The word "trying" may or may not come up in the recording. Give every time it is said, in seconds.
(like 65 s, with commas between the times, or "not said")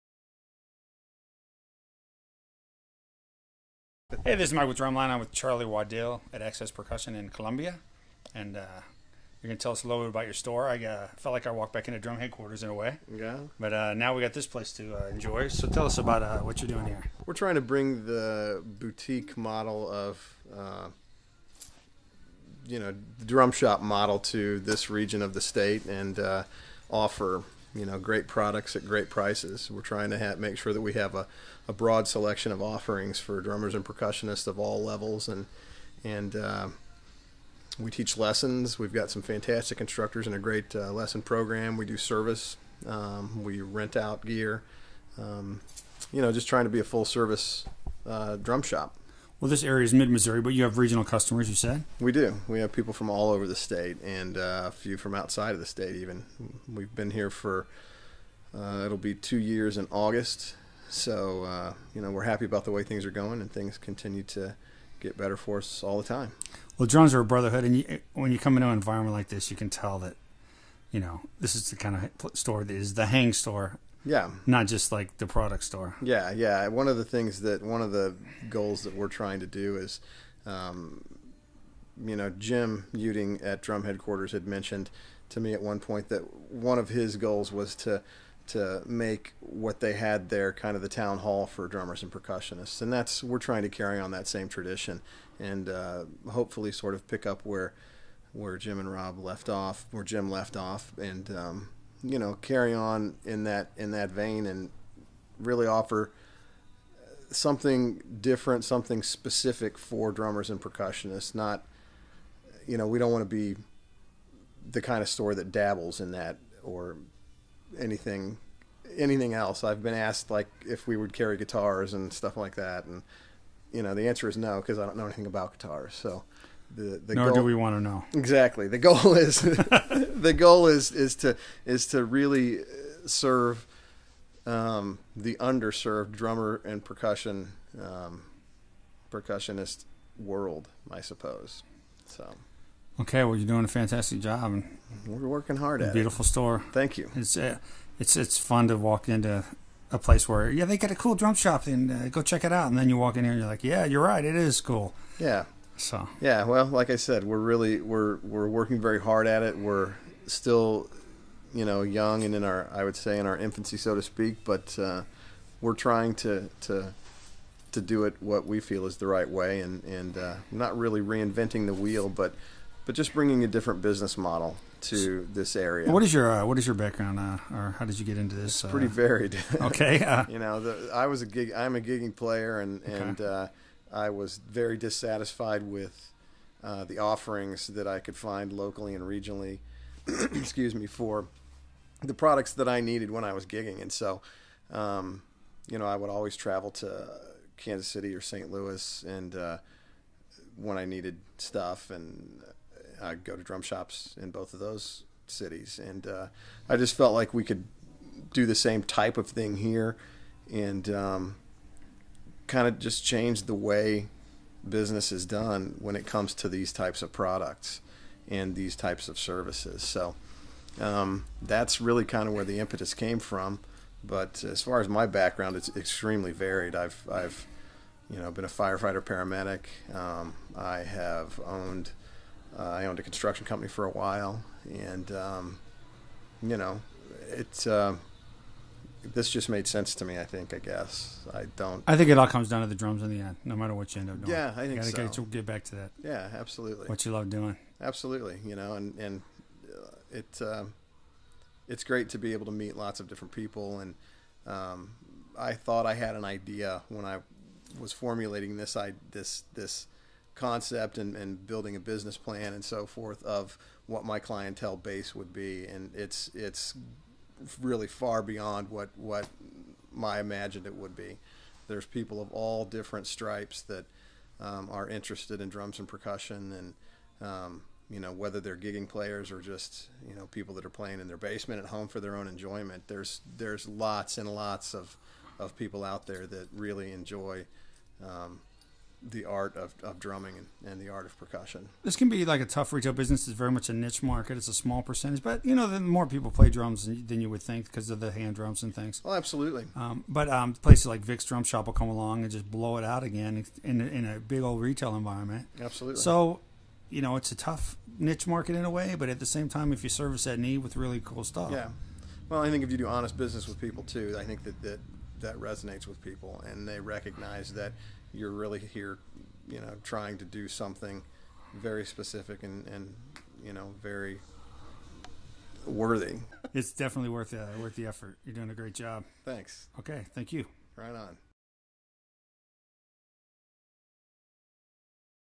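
17 s, 29 s, 46 s, 79 s, 93 s, 165 s, 319 s.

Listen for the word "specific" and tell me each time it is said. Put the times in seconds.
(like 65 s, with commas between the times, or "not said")
109 s, 321 s.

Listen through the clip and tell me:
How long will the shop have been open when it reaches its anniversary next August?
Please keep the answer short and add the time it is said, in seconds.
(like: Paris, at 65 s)
2 years, at 59 s.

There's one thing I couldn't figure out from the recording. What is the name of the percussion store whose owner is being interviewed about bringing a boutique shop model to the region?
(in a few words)
Access Percussion.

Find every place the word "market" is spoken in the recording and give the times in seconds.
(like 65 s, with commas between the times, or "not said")
294 s, 308 s.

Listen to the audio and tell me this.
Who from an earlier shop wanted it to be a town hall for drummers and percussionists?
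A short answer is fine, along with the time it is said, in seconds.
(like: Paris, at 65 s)
Jim Uting, at 82 s.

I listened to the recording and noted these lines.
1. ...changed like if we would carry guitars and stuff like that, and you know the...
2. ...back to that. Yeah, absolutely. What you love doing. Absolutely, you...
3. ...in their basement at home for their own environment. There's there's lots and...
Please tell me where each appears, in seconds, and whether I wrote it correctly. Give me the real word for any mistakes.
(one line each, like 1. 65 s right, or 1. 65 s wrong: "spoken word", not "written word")
1. 119 s wrong: "asked", not "changed"
2. 245 s right
3. 280 s wrong: "enjoyment", not "environment".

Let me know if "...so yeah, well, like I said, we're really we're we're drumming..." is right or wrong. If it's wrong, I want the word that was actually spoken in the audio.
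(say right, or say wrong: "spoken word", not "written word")
wrong: "working", not "drumming".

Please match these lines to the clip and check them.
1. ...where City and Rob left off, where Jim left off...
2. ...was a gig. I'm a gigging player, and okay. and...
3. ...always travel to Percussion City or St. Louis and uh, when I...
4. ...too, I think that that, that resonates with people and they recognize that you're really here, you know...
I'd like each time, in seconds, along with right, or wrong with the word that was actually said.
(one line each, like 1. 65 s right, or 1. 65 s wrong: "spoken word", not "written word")
1. 98 s wrong: "Jim", not "City"
2. 181 s right
3. 196 s wrong: "Kansas", not "Percussion"
4. 313 s right.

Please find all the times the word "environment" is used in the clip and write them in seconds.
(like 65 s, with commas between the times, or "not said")
68 s, 304 s.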